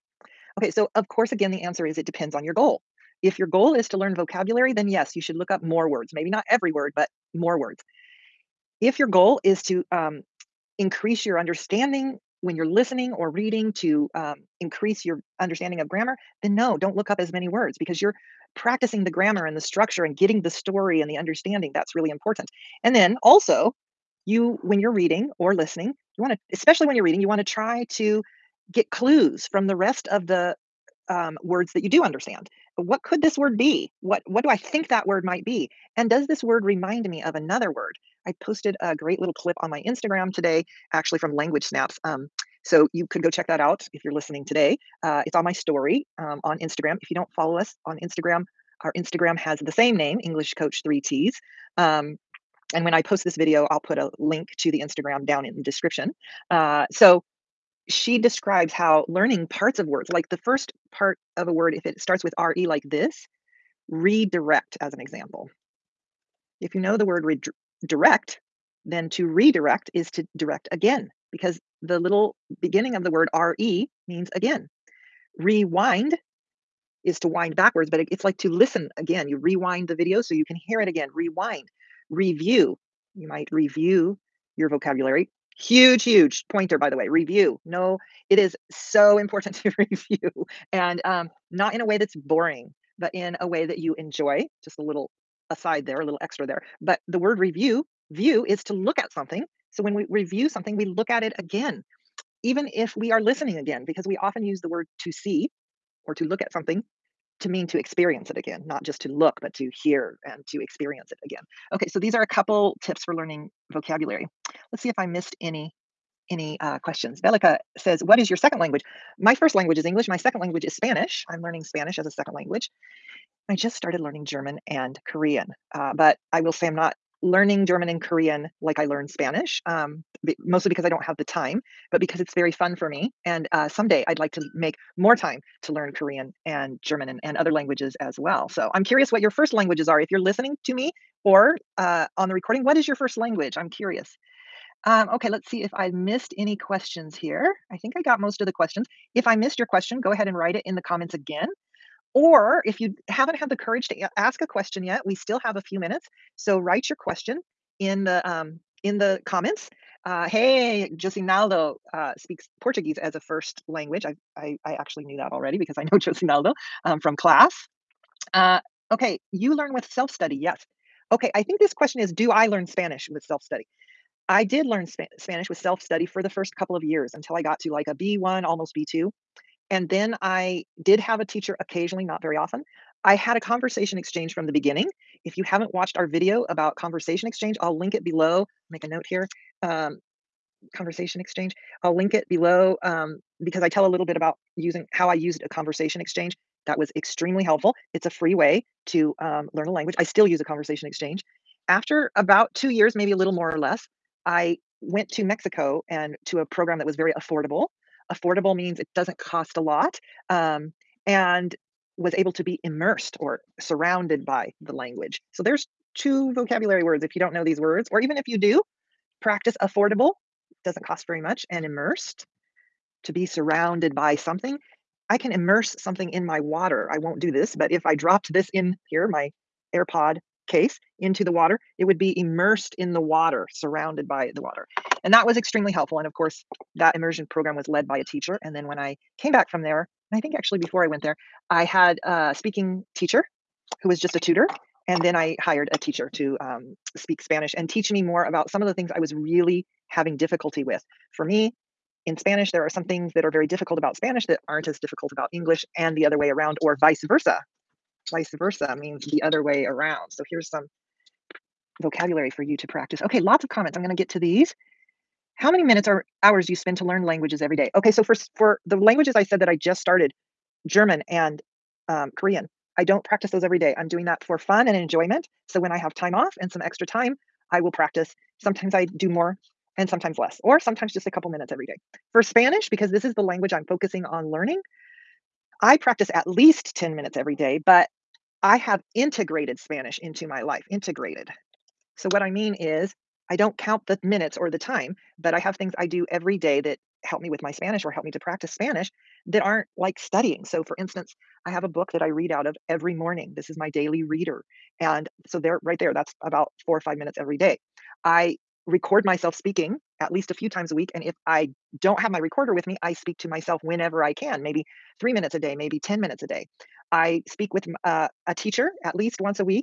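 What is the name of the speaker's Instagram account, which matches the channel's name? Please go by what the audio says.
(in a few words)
English Coach Three T's.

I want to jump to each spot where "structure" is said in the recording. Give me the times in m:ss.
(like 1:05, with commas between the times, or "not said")
0:19.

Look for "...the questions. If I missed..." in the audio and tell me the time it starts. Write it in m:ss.
2:28.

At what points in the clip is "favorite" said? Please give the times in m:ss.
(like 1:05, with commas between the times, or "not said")
not said.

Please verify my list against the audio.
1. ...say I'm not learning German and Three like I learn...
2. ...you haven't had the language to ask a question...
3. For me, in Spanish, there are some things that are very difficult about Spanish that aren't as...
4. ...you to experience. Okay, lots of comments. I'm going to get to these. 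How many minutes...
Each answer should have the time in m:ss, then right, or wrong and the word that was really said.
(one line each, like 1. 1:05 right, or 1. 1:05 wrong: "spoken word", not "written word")
1. 2:06 wrong: "Korean", not "Three"
2. 2:32 wrong: "courage", not "language"
3. 4:11 right
4. 4:22 wrong: "practice", not "experience".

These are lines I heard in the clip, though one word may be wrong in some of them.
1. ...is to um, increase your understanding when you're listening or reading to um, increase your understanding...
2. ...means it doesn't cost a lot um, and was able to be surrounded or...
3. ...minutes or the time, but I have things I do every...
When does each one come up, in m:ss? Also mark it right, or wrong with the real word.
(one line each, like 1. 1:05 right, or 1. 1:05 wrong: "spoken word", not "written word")
1. 0:09 right
2. 3:28 wrong: "immersed", not "surrounded"
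3. 4:54 right.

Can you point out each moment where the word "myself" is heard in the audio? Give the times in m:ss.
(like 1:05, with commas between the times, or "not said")
5:09, 5:13.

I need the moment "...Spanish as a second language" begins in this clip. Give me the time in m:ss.
2:01.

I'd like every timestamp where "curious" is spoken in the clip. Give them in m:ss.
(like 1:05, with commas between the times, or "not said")
2:18, 2:23.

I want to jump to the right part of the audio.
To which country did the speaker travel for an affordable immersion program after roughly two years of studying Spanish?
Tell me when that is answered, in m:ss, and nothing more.
3:25.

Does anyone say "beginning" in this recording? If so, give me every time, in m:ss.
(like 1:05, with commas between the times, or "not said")
1:12, 3:04.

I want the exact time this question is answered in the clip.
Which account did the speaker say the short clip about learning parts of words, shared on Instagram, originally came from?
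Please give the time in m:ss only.
0:41.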